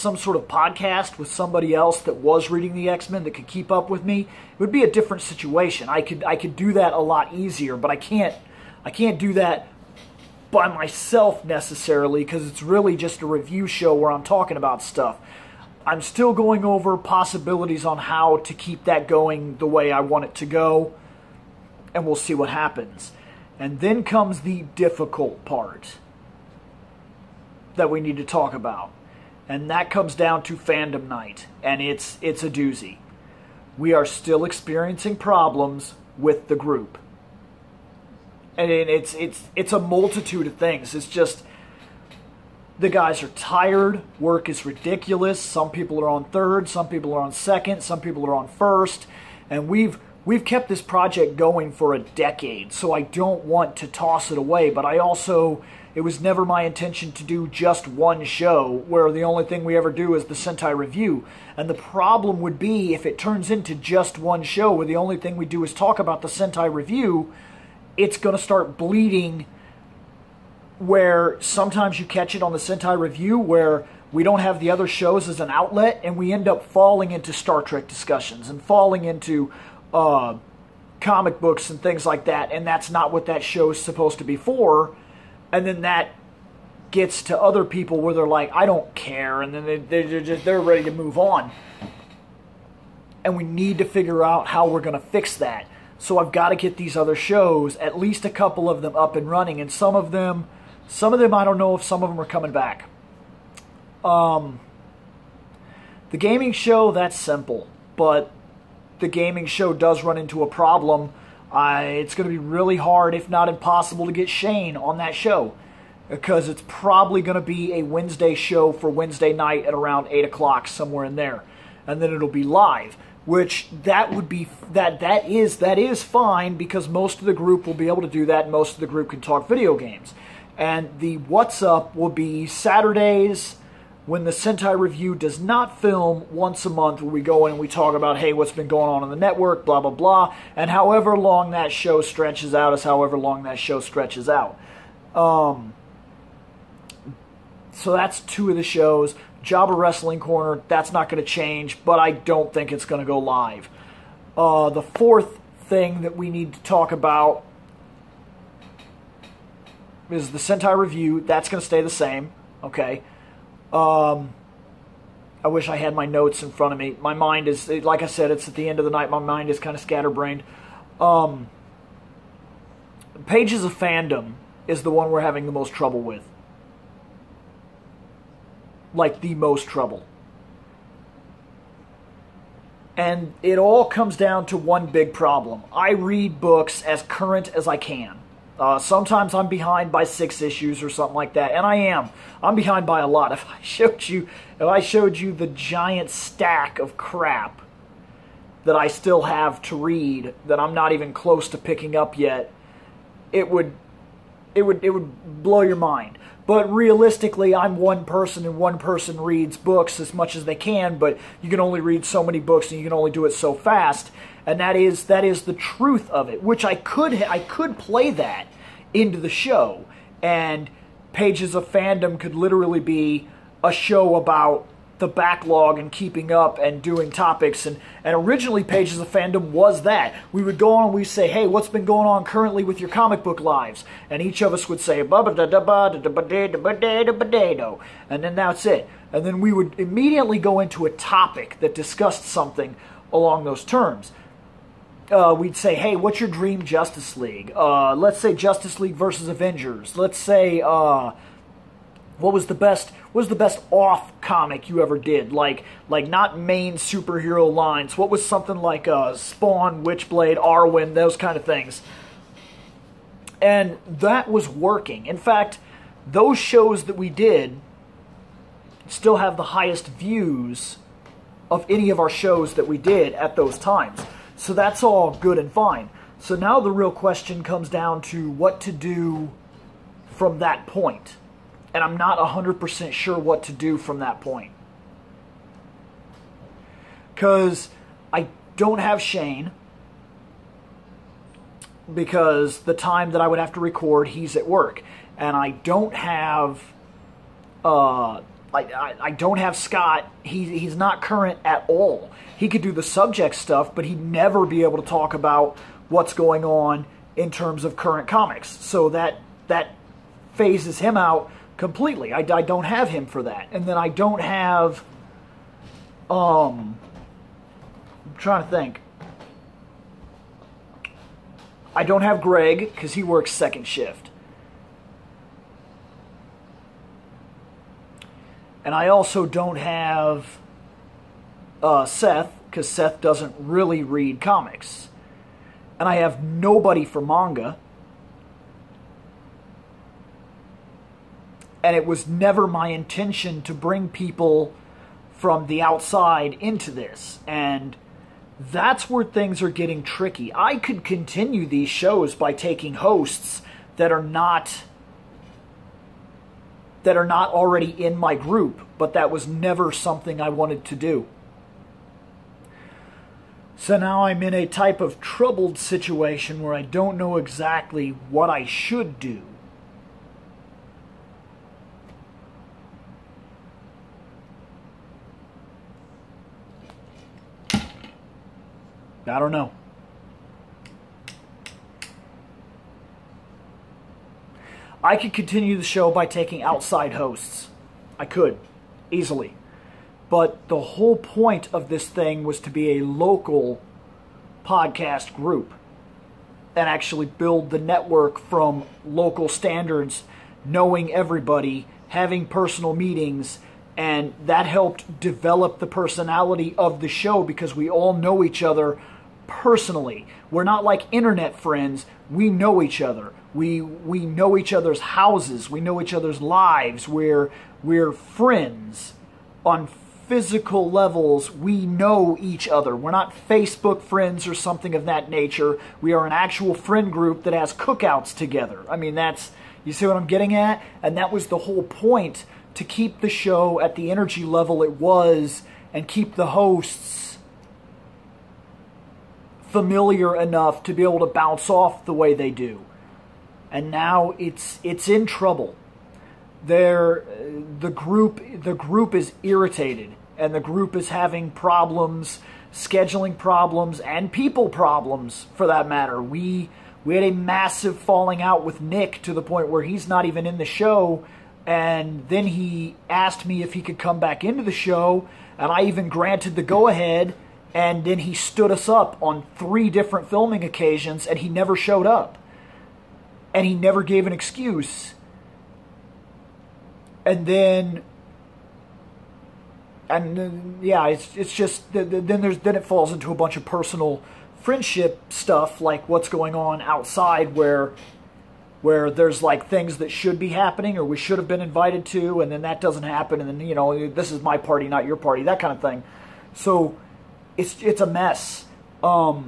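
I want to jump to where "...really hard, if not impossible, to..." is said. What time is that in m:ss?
1:52.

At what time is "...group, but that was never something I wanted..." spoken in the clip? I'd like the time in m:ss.
5:58.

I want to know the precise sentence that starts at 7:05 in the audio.
We are an actual friend group that has cookouts together.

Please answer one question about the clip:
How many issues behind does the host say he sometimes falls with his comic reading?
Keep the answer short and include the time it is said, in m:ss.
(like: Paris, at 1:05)
6, at 3:10.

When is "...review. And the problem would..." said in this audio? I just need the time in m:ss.
1:00.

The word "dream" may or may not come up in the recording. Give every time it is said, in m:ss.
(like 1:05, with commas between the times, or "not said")
4:06.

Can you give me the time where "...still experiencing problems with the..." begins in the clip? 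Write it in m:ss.
0:34.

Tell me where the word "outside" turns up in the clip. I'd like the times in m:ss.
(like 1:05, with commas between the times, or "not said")
5:45, 6:26, 8:06.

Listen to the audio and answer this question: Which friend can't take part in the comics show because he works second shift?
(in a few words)
Greg.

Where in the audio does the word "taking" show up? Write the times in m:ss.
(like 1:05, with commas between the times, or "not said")
5:52, 6:26.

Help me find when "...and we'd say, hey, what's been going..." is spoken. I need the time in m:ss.
3:50.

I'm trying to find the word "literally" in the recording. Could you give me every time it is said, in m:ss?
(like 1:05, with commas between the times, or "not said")
3:42.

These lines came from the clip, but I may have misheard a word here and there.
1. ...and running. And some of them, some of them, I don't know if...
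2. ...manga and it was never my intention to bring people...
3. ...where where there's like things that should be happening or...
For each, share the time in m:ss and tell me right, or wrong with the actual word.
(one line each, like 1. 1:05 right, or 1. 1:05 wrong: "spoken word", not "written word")
1. 1:39 right
2. 5:37 right
3. 8:07 right.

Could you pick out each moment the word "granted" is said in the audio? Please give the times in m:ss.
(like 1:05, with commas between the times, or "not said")
7:45.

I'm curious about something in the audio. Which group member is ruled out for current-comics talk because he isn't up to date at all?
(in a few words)
Scott.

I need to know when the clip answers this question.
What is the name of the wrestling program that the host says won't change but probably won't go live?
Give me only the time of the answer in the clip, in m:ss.
2:29.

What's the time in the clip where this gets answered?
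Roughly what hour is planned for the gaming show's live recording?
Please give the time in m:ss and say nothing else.
2:00.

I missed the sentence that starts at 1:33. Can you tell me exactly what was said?
And we need to figure out how we're going to fix that.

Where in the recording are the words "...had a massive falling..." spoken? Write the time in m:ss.
7:36.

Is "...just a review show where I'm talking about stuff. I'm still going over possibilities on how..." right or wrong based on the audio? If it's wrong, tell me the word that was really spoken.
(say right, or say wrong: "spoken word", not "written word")
right.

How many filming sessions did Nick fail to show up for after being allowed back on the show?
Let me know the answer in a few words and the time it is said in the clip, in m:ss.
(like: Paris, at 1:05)
3, at 7:49.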